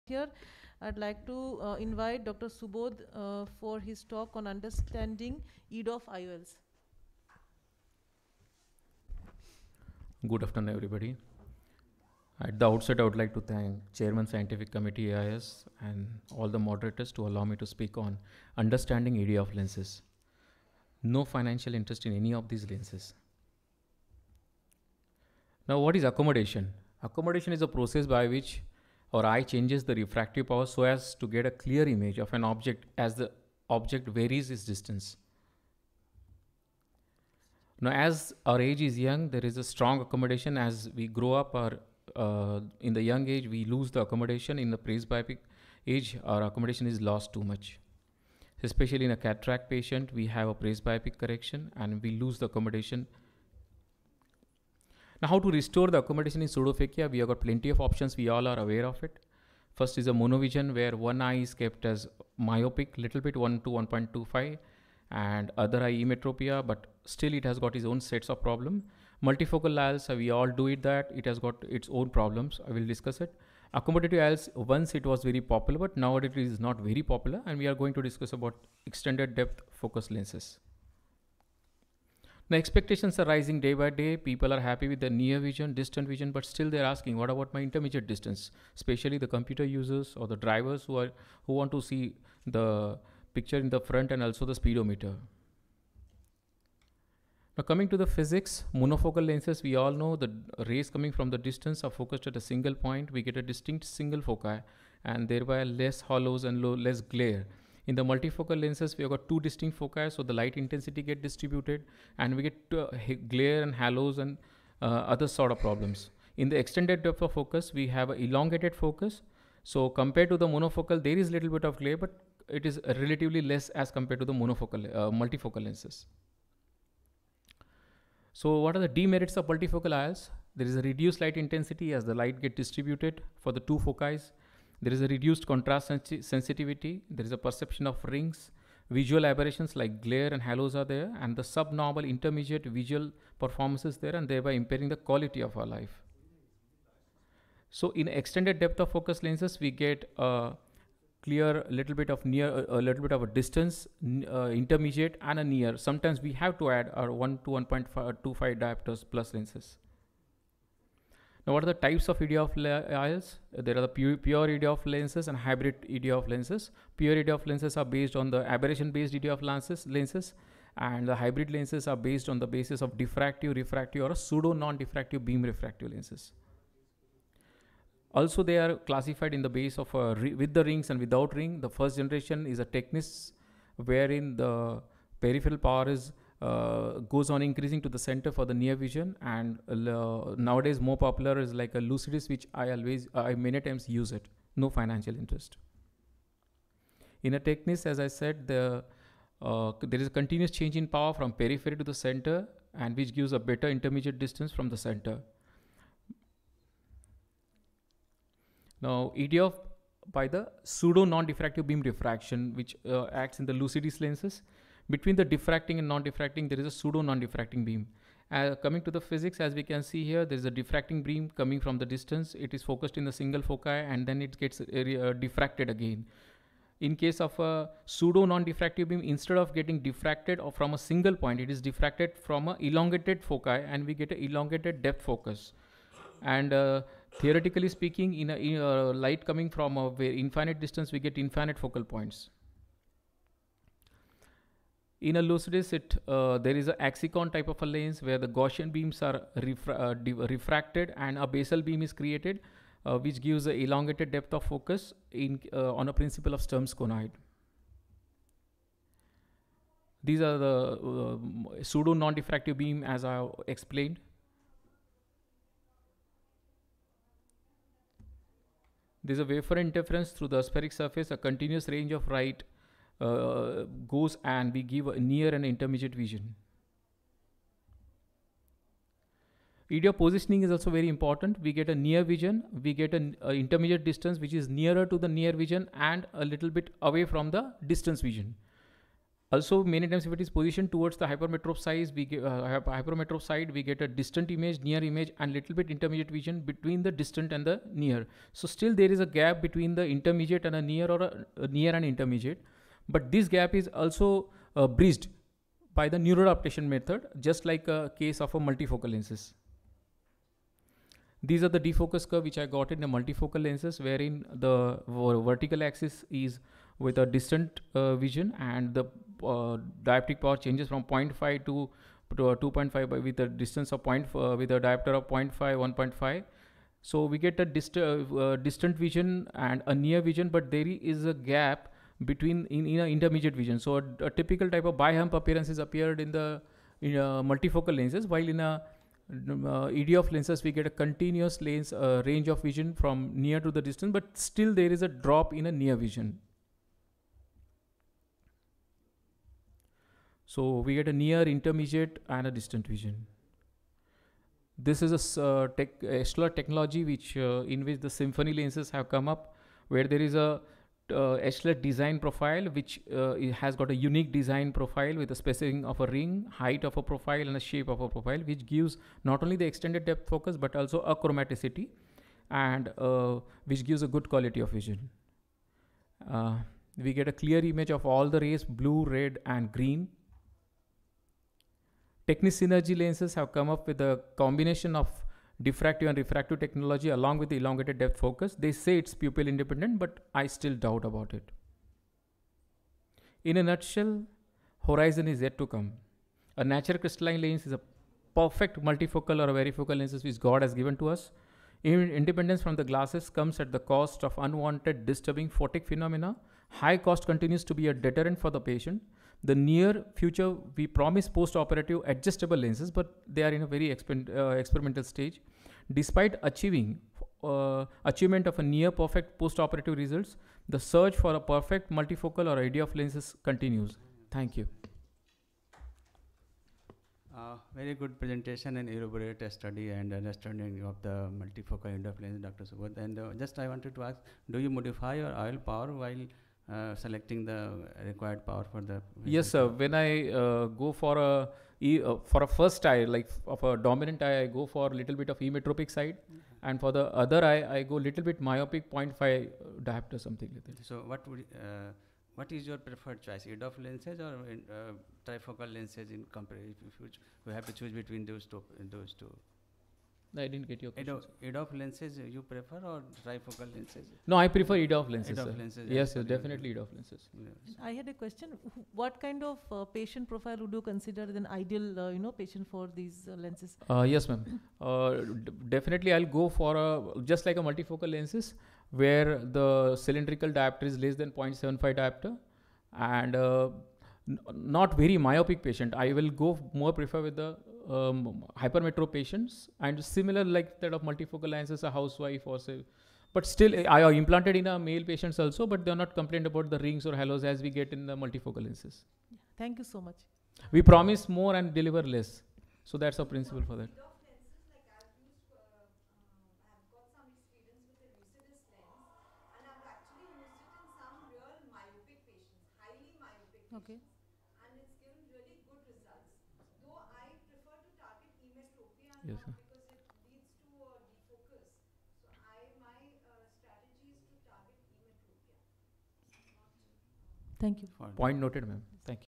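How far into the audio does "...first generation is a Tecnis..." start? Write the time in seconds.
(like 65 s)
181 s.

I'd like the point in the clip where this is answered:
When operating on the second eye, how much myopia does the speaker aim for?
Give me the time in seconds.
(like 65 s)
448 s.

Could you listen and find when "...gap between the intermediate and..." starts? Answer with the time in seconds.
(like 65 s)
299 s.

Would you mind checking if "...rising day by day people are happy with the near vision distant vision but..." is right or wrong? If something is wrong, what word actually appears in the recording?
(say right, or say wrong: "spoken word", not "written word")
right.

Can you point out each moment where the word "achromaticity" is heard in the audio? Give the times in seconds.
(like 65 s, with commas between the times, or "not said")
370 s.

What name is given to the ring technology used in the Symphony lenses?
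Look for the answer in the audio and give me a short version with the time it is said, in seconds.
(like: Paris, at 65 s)
echelette technology, at 355 s.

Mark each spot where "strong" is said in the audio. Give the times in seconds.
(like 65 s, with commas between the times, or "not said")
39 s.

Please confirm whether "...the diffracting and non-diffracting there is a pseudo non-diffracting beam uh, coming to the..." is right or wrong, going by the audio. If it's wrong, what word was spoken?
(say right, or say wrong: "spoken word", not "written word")
right.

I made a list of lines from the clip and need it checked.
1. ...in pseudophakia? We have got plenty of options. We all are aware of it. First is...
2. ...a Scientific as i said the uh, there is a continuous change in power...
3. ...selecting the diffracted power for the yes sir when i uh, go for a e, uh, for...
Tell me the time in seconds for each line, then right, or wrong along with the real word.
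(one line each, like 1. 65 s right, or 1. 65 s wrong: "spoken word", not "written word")
1. 56 s right
2. 197 s wrong: "Tecnis", not "Scientific"
3. 436 s wrong: "required", not "diffracted".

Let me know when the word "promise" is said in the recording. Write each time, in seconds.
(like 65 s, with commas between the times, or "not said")
410 s, 500 s.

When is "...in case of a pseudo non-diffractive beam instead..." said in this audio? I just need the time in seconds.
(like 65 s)
226 s.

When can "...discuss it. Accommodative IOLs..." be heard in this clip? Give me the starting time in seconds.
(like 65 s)
72 s.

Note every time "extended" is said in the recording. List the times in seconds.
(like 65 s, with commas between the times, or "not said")
78 s, 116 s, 148 s, 369 s.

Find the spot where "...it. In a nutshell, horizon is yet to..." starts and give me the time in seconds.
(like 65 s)
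391 s.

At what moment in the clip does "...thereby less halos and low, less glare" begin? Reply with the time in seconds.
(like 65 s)
105 s.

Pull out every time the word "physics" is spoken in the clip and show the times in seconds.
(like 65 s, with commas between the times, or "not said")
98 s, 219 s.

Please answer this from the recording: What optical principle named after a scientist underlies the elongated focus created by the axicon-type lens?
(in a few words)
Sturm's conoid.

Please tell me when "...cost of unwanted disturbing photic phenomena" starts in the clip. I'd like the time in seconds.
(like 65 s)
403 s.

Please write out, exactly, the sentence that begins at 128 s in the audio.
So what are the demerits of multifocal eyes?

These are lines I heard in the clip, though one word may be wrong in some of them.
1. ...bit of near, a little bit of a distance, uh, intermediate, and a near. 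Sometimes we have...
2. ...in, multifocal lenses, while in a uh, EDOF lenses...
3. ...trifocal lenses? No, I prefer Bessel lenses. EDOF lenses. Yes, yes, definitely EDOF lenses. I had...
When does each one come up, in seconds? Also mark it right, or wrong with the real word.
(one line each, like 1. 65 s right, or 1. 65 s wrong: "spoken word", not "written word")
1. 151 s right
2. 336 s right
3. 463 s wrong: "EDOF", not "Bessel".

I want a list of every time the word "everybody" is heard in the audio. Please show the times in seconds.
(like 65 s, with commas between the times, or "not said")
10 s.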